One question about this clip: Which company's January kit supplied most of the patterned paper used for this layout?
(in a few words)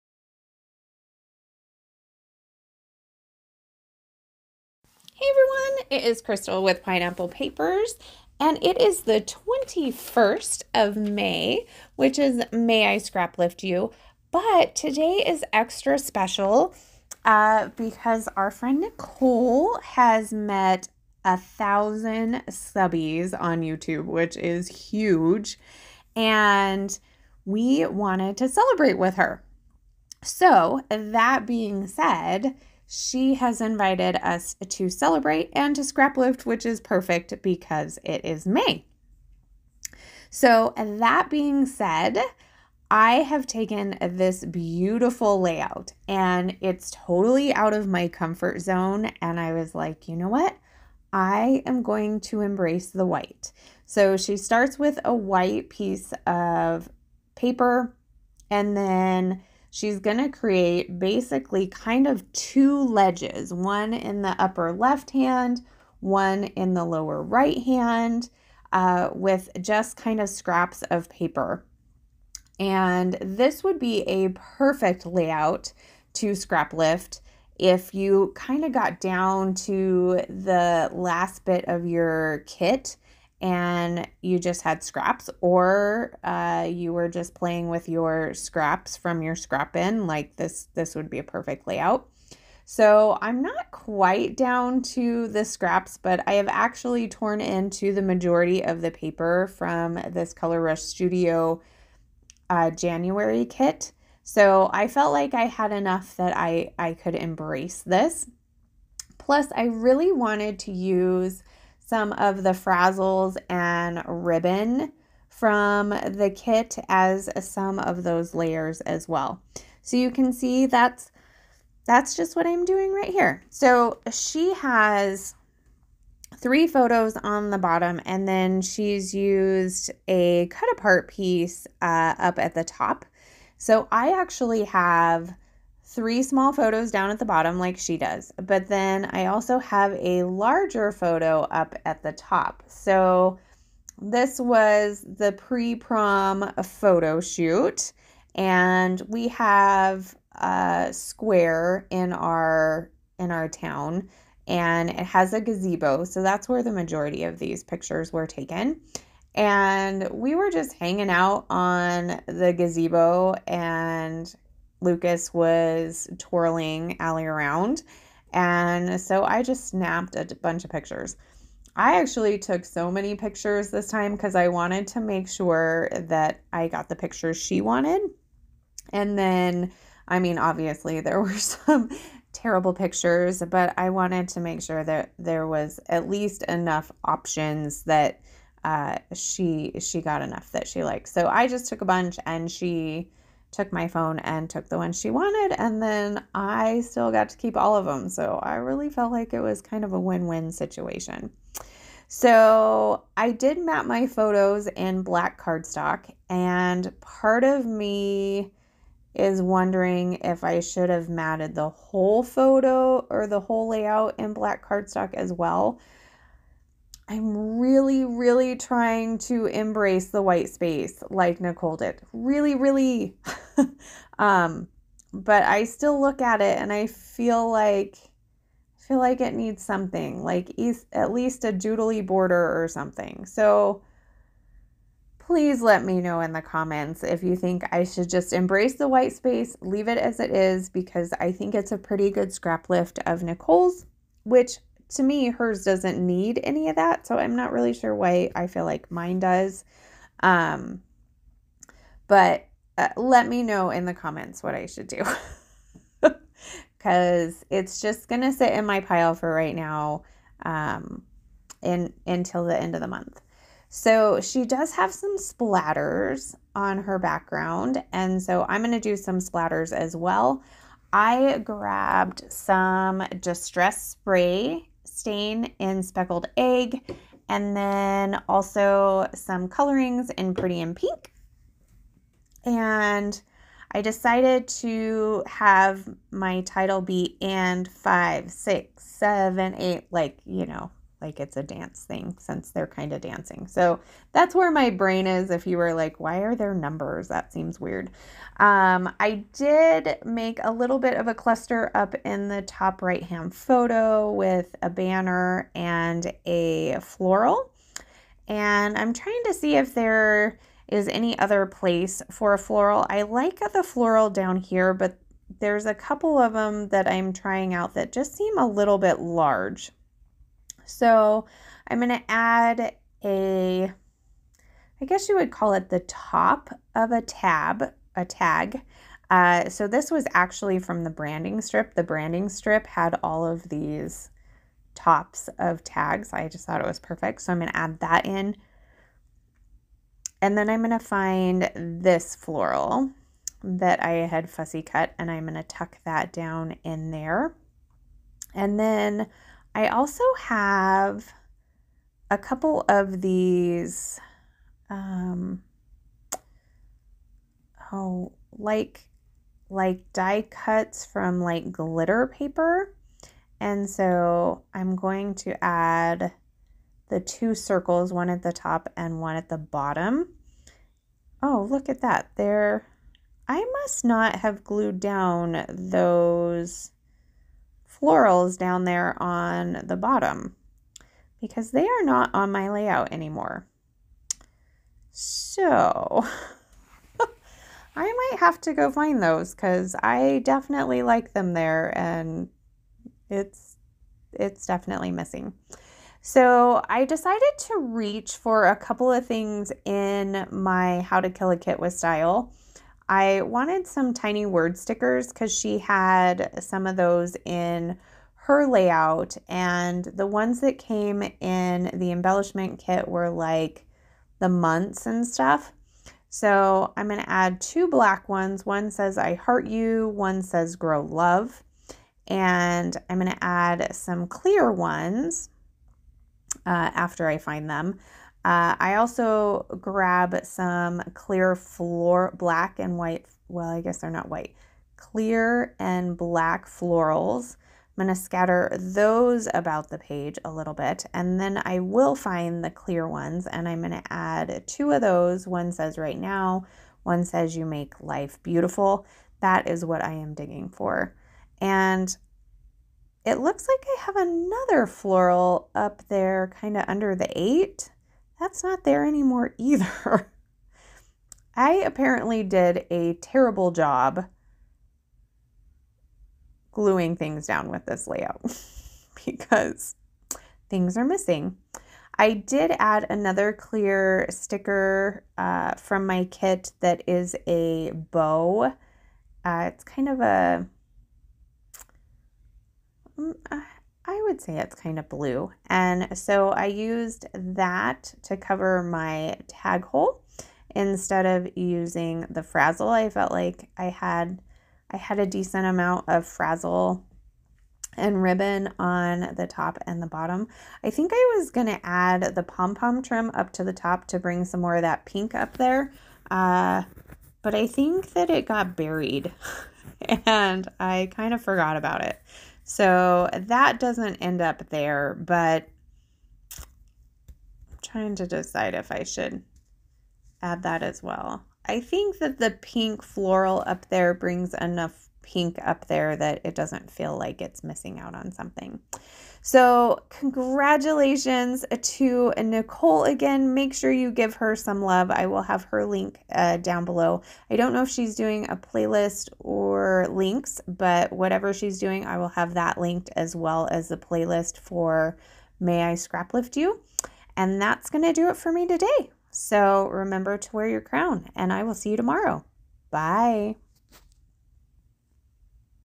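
Color Rush Studio.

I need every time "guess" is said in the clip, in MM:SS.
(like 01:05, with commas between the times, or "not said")
05:24, 07:13.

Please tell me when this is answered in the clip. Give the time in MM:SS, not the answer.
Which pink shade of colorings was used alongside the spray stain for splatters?
04:40.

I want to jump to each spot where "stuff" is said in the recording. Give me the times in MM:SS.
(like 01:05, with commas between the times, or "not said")
06:55.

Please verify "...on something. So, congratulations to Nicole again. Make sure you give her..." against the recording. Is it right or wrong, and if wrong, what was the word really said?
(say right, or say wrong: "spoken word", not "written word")
right.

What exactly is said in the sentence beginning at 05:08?
And I'm trying to see if there is any other place for a floral.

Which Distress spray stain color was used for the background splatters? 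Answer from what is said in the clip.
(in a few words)
Speckled Egg.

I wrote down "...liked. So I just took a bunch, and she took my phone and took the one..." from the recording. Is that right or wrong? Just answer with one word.
right.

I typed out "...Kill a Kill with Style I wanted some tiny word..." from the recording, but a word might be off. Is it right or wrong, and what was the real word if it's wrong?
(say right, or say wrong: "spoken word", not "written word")
wrong: "Kit", not "Kill".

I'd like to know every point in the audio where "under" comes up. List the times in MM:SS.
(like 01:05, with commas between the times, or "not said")
07:36.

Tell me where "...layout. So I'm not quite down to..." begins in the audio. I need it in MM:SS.
01:31.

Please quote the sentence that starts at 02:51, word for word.
I actually took so many pictures this time because I wanted to make sure that I got the pictures she wanted.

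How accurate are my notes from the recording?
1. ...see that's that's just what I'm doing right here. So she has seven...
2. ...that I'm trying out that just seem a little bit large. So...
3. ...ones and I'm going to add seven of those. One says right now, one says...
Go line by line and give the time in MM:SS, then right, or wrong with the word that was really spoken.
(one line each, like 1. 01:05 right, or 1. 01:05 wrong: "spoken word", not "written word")
1. 02:00 wrong: "three", not "seven"
2. 05:16 right
3. 07:22 wrong: "two", not "seven".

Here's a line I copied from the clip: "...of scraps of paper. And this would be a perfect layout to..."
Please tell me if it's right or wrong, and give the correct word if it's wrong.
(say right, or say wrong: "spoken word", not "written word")
right.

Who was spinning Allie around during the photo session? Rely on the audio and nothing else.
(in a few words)
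Lucas.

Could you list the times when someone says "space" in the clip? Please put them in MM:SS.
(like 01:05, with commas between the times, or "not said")
03:40, 03:59.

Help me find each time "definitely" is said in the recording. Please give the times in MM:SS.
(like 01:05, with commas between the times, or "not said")
06:30, 06:34.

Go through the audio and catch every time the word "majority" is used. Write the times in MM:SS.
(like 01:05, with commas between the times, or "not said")
01:38, 02:36.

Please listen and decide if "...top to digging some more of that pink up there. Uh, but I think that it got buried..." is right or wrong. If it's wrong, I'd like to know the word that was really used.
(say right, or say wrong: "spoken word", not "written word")
wrong: "bring", not "digging".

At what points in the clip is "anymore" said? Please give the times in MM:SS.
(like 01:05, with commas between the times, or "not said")
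06:22, 07:38.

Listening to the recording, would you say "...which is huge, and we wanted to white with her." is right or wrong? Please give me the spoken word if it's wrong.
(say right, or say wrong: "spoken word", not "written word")
wrong: "celebrate", not "white".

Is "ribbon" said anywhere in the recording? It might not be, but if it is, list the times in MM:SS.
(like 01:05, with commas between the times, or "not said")
01:54, 08:18.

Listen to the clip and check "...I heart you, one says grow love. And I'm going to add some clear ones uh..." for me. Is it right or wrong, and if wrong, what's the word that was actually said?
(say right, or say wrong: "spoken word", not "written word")
right.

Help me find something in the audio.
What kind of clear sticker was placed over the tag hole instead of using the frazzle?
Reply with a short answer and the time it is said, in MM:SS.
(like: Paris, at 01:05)
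a bow, at 07:57.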